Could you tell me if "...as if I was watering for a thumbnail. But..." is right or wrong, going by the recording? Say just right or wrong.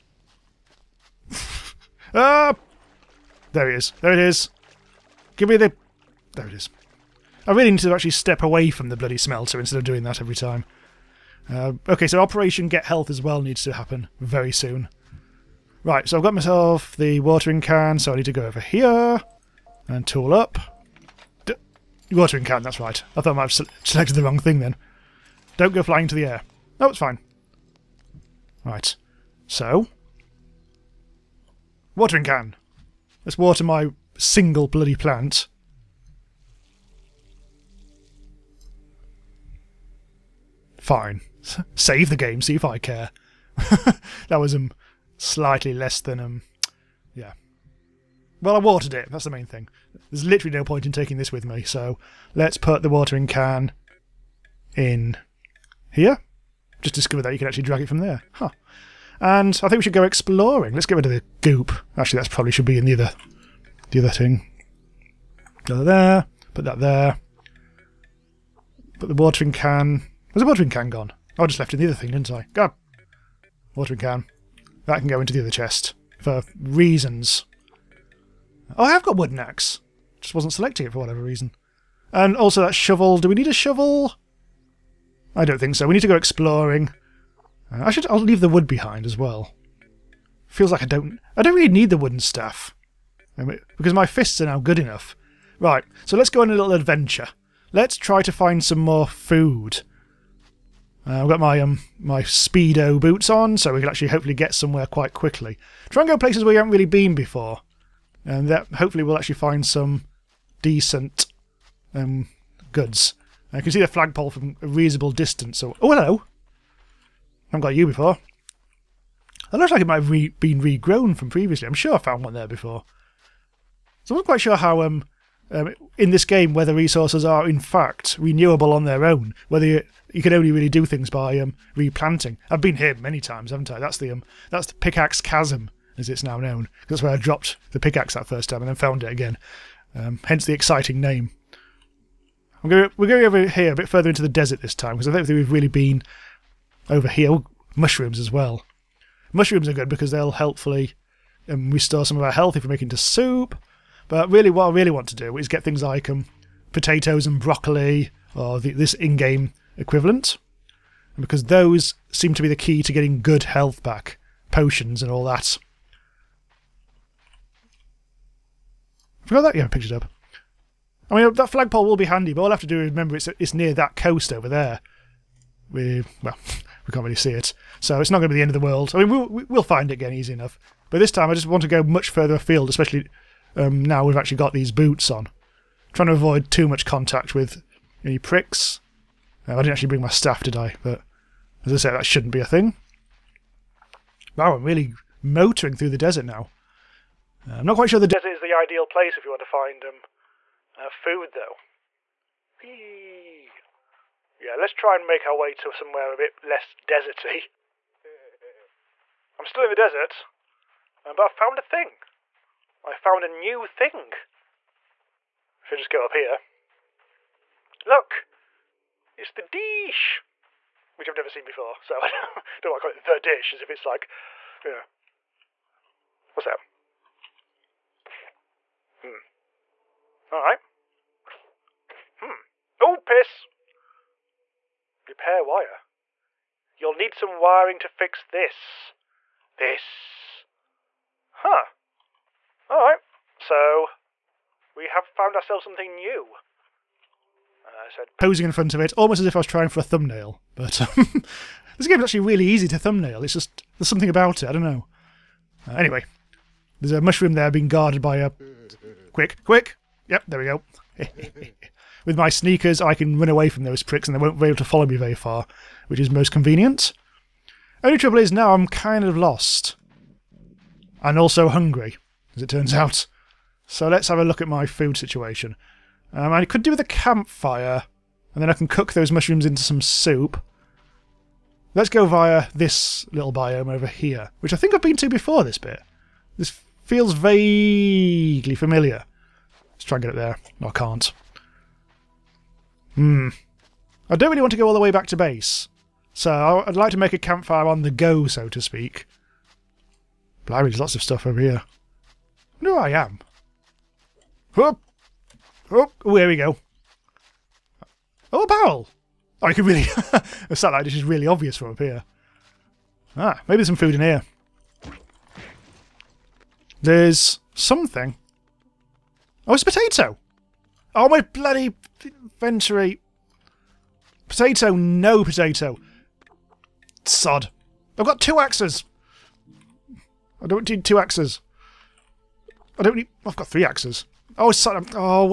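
wrong.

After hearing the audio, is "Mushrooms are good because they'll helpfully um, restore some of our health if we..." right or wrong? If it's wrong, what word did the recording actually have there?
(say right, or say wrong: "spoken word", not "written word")
right.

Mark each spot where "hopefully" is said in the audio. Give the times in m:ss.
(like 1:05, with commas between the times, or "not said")
1:44, 1:48.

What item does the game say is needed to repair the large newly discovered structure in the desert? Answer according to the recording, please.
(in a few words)
wire.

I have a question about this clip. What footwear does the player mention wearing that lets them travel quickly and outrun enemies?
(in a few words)
speedo boots.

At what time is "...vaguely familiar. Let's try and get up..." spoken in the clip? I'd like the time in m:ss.
4:47.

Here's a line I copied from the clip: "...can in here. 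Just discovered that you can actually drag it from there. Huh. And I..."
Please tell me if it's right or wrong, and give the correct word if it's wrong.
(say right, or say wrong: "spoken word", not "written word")
right.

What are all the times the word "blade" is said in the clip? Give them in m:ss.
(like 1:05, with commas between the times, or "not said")
not said.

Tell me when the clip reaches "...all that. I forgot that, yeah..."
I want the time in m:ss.
2:45.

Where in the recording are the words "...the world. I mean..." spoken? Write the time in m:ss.
2:58.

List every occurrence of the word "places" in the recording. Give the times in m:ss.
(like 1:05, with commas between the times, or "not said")
1:46, 3:18.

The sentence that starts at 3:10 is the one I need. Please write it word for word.
But as I said, that shouldn't be a thing.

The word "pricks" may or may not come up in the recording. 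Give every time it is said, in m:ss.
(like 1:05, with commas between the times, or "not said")
3:08, 4:23.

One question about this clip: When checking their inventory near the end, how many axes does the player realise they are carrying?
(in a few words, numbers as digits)
3.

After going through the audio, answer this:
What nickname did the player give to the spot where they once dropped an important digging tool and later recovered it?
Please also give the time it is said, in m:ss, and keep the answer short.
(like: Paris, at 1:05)
pickaxe chasm, at 2:14.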